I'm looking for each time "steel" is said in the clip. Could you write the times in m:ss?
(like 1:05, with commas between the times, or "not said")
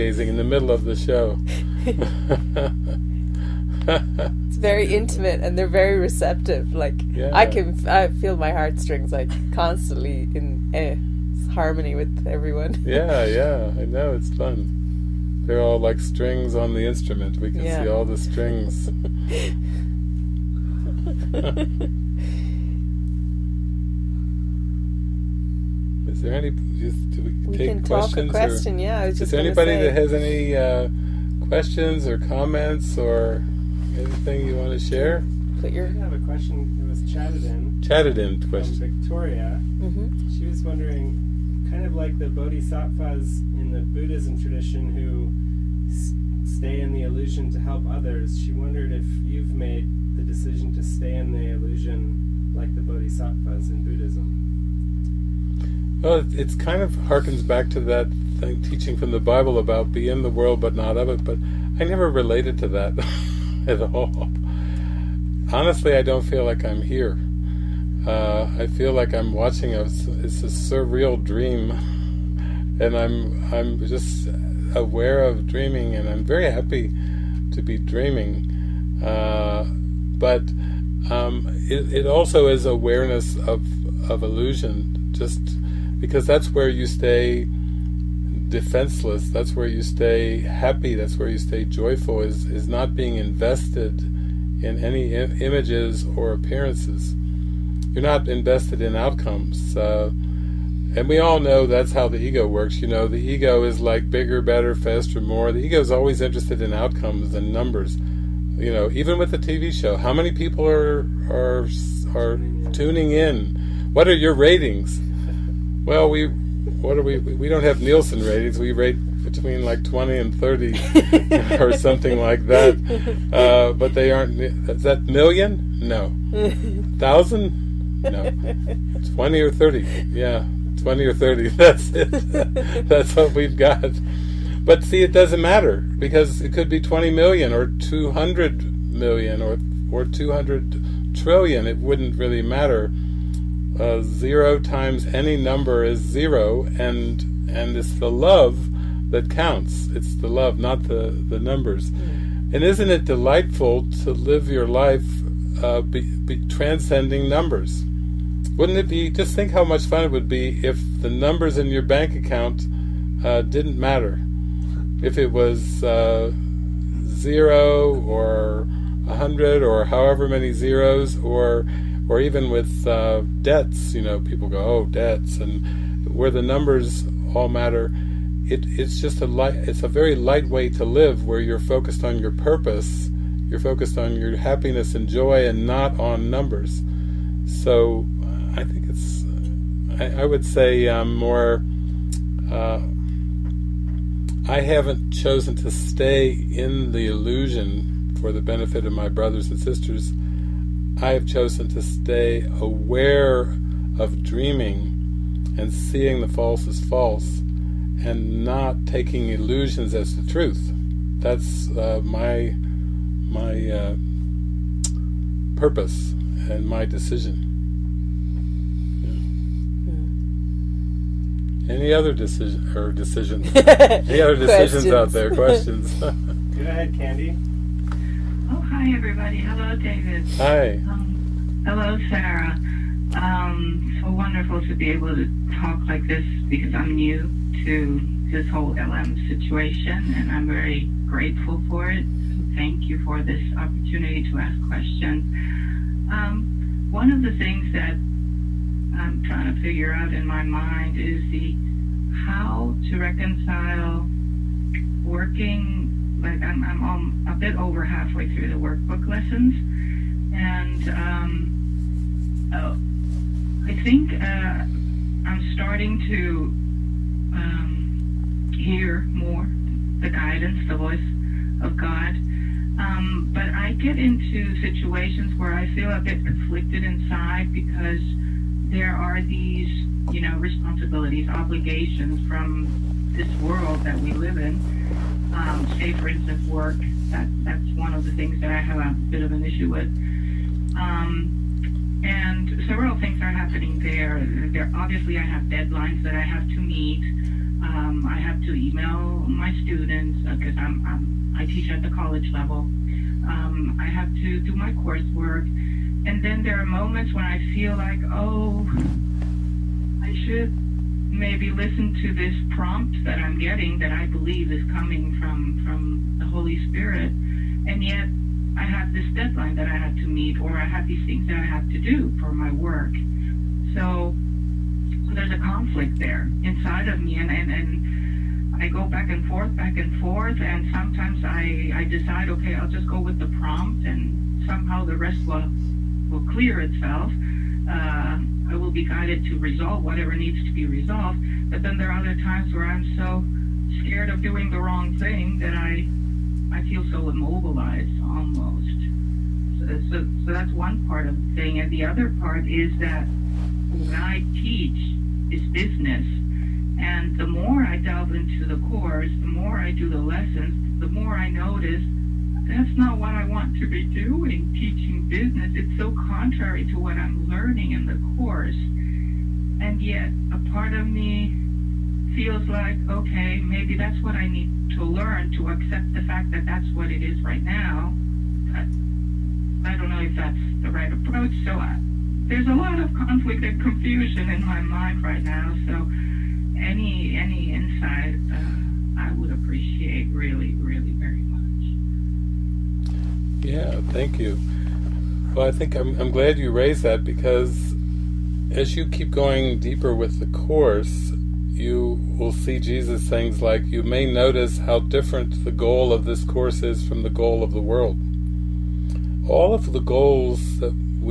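not said.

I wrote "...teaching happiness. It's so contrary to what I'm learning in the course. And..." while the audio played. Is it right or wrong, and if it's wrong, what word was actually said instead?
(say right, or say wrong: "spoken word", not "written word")
wrong: "business", not "happiness".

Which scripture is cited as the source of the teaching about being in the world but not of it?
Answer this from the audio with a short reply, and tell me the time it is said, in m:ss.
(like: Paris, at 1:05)
the Bible, at 0:59.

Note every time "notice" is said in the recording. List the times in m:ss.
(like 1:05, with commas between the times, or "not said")
6:01, 6:44.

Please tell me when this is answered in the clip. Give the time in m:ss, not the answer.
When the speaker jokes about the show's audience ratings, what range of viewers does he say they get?
1:59.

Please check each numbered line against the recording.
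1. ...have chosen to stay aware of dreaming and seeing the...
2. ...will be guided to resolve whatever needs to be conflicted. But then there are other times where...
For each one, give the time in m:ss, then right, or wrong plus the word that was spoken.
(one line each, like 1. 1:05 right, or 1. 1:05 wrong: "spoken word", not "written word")
1. 3:21 right
2. 5:38 wrong: "resolved", not "conflicted".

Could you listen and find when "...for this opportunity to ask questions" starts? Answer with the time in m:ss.
4:02.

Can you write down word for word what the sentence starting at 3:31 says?
That's uh, my my uh, purpose and my decision.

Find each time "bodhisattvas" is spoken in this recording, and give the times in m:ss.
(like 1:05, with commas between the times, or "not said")
0:42, 0:52.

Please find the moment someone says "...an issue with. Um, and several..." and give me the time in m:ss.
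4:49.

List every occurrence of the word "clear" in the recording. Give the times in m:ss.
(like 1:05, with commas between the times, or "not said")
5:36.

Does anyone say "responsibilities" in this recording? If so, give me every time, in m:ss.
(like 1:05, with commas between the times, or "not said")
4:40.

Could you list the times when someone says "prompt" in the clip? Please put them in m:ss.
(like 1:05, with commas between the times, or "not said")
5:12, 5:33.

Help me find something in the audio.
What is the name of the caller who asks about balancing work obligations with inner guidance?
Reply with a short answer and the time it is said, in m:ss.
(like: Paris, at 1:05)
Candy, at 3:46.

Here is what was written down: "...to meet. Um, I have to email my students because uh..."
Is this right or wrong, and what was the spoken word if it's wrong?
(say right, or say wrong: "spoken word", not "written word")
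right.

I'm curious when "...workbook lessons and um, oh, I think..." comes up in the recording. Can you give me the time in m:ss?
4:18.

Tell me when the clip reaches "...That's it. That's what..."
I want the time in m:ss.
2:11.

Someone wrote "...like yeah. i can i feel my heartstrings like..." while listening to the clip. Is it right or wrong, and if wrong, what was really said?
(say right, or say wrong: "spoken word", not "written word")
right.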